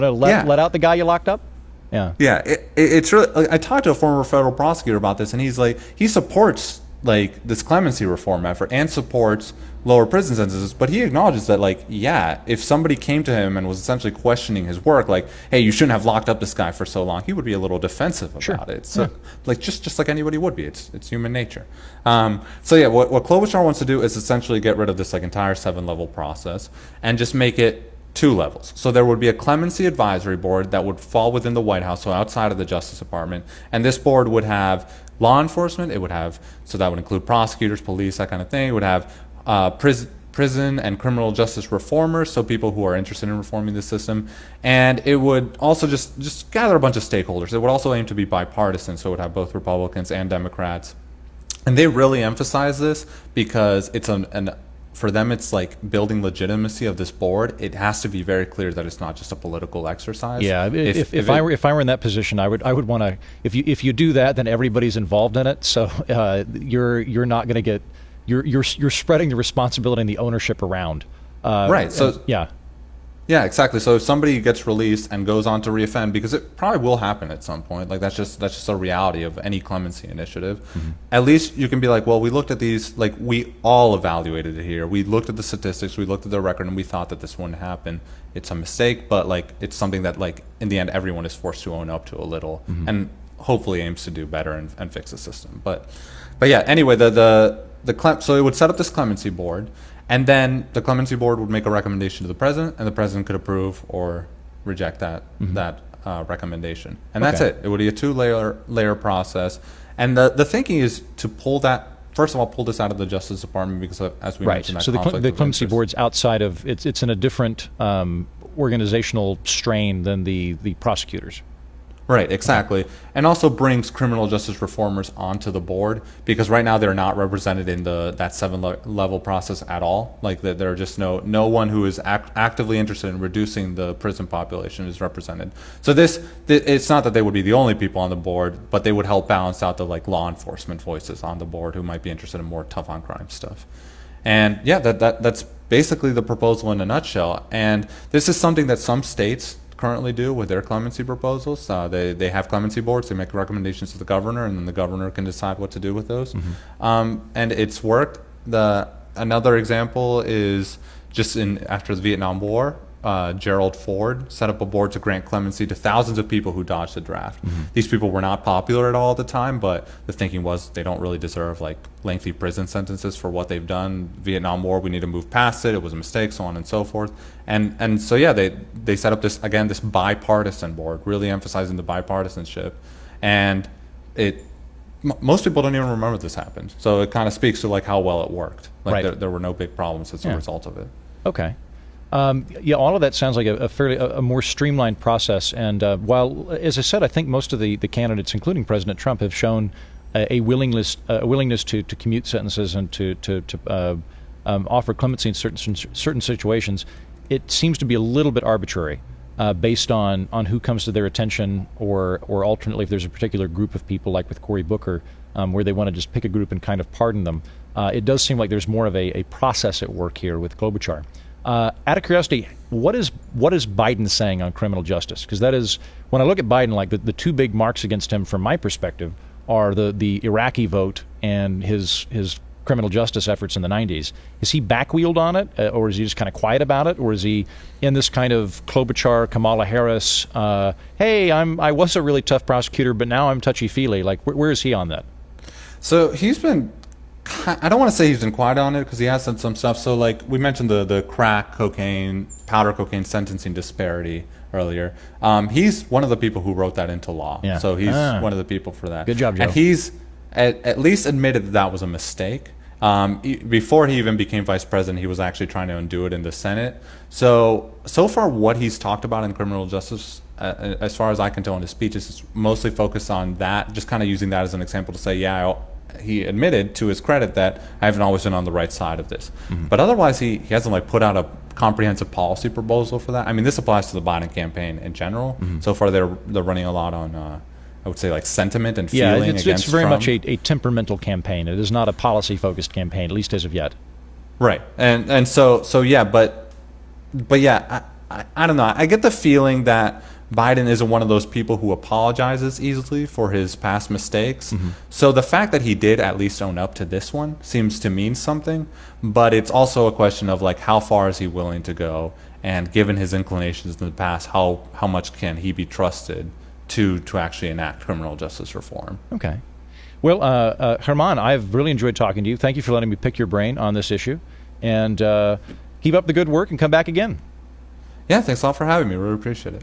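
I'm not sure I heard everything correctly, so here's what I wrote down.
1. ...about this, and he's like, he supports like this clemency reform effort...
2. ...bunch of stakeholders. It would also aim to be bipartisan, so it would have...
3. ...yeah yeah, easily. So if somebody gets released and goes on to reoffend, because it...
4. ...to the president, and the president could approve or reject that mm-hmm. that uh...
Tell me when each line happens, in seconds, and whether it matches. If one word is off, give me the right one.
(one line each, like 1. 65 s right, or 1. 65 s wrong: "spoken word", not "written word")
1. 4 s right
2. 46 s right
3. 72 s wrong: "exactly", not "easily"
4. 102 s right.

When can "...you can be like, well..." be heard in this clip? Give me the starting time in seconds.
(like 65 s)
81 s.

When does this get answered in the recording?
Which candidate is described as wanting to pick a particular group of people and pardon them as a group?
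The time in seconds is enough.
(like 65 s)
214 s.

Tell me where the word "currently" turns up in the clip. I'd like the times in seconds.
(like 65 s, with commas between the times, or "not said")
149 s.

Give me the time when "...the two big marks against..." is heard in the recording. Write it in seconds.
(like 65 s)
226 s.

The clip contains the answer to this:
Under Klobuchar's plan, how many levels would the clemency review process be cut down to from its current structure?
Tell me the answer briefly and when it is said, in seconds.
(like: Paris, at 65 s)
2, at 28 s.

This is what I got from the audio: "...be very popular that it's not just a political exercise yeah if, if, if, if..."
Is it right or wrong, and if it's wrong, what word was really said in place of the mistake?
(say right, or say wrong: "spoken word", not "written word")
wrong: "clear", not "popular".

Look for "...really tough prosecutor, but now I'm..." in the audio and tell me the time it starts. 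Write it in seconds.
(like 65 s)
242 s.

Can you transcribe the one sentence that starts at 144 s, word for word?
And yeah, that, that that's basically the proposal in a nutshell.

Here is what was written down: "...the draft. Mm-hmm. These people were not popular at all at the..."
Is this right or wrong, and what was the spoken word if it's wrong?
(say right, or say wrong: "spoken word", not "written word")
right.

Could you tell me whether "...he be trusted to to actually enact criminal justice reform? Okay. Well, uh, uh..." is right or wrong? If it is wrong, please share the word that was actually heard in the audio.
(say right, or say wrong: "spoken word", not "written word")
right.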